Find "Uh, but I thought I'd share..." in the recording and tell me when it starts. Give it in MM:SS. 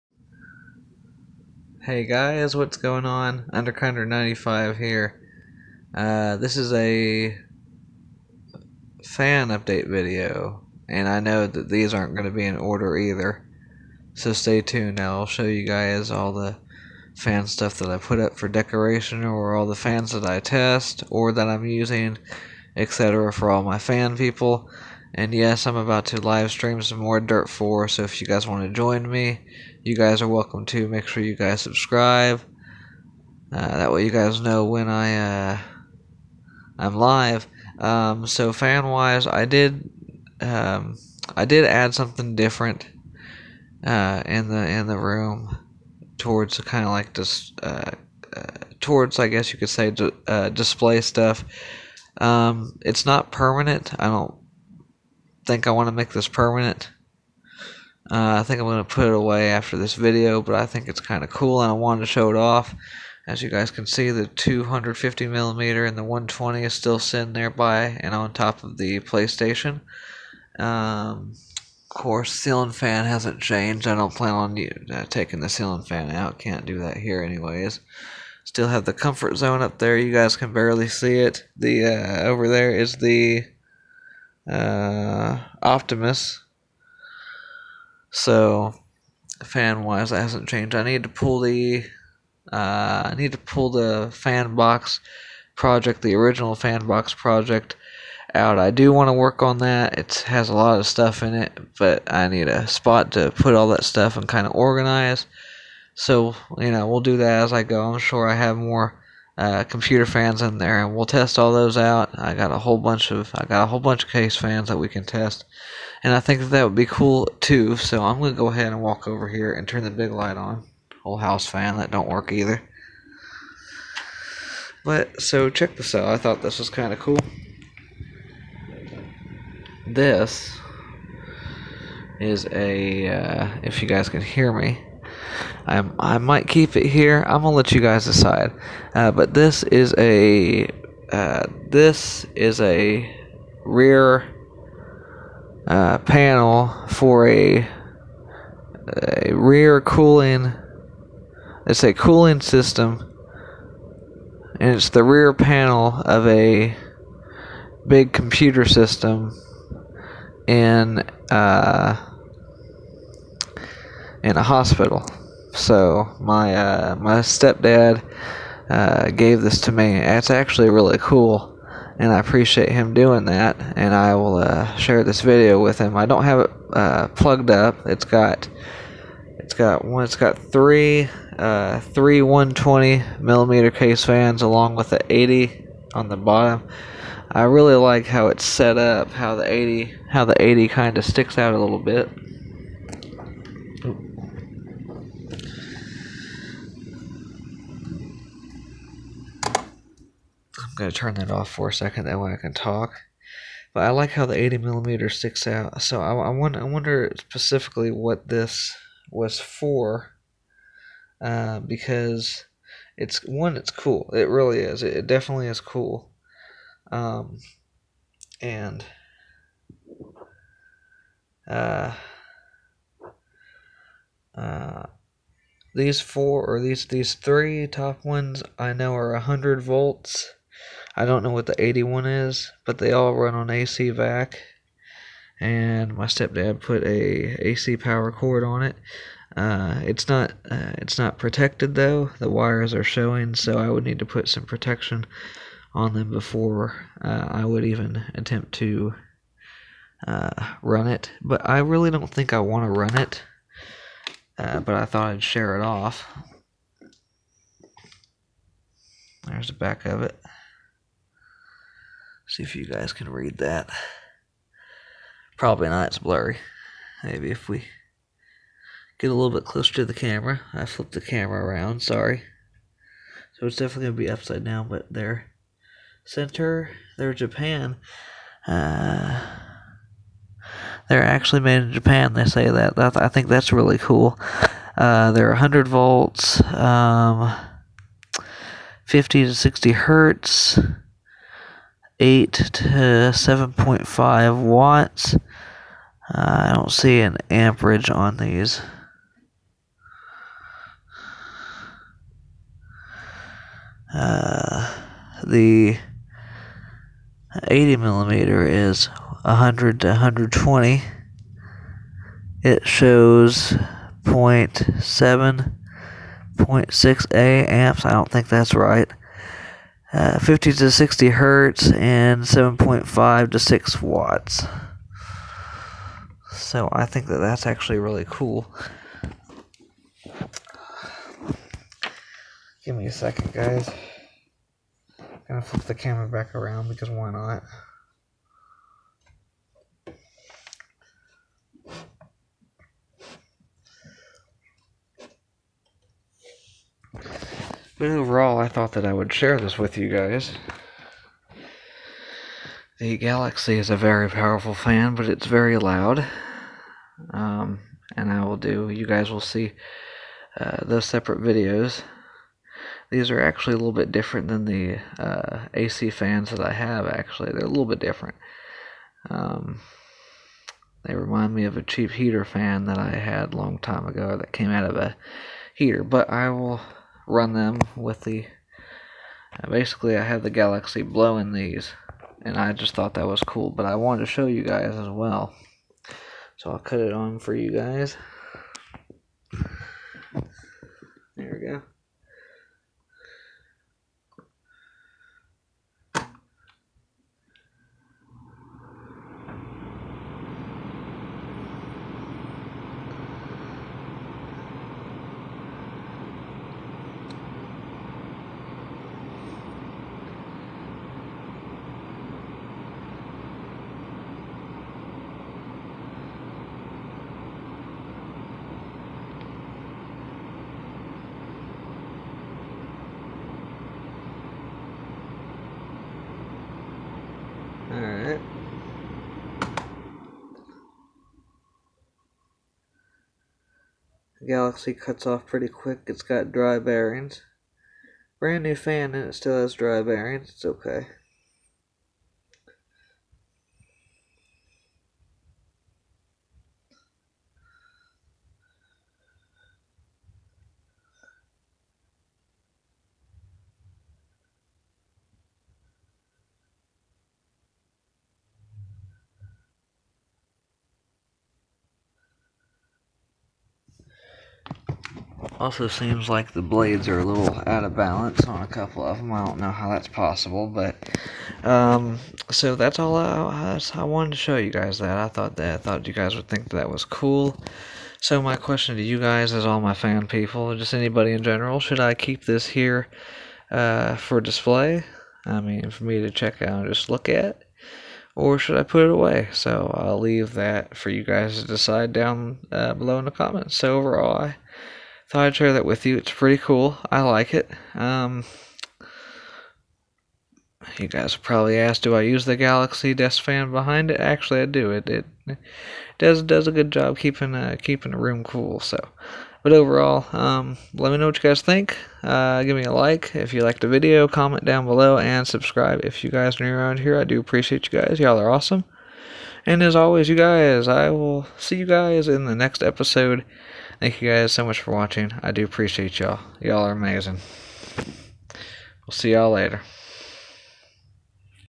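04:14.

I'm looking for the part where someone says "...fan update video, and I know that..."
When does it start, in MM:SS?
00:09.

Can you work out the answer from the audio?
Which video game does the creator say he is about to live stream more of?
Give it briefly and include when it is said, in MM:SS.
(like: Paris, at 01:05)
Dirt 4, at 00:27.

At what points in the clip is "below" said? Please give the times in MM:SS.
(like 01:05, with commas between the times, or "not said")
08:12, 08:34.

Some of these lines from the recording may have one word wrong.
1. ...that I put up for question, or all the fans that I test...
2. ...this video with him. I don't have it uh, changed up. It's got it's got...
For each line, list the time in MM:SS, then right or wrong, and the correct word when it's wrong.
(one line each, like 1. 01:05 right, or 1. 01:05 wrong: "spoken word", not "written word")
1. 00:17 wrong: "decoration", not "question"
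2. 02:55 wrong: "plugged", not "changed".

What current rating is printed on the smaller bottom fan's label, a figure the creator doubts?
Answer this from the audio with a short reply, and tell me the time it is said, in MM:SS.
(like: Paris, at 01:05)
0.7, 0.6 amps, at 05:14.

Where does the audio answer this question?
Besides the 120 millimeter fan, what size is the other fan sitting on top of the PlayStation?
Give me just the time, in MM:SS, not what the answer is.
01:04.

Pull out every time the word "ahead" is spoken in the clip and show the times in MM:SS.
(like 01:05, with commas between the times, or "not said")
01:58.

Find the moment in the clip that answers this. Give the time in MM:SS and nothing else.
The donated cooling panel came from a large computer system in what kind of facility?
02:44.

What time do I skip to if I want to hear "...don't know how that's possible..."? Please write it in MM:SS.
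07:49.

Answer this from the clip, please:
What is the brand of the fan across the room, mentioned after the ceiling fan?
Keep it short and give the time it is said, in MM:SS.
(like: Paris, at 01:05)
Optimus, at 01:25.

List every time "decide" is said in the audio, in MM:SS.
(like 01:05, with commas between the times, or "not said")
02:18, 08:11.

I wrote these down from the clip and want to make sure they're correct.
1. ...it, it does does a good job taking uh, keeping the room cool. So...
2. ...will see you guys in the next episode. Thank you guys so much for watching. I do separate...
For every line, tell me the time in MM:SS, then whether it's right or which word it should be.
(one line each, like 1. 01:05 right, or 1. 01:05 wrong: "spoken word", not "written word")
1. 08:24 wrong: "keeping", not "taking"
2. 08:40 wrong: "appreciate", not "separate".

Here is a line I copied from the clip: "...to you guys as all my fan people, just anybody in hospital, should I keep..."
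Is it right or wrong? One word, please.
wrong.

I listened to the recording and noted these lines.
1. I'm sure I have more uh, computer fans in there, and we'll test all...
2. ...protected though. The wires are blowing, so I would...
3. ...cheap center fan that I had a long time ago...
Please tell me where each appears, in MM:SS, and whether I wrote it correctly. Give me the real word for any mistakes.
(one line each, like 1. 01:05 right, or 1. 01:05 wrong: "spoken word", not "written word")
1. 01:47 right
2. 04:01 wrong: "showing", not "blowing"
3. 06:11 wrong: "heater", not "center".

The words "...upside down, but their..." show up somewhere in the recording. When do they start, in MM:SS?
04:34.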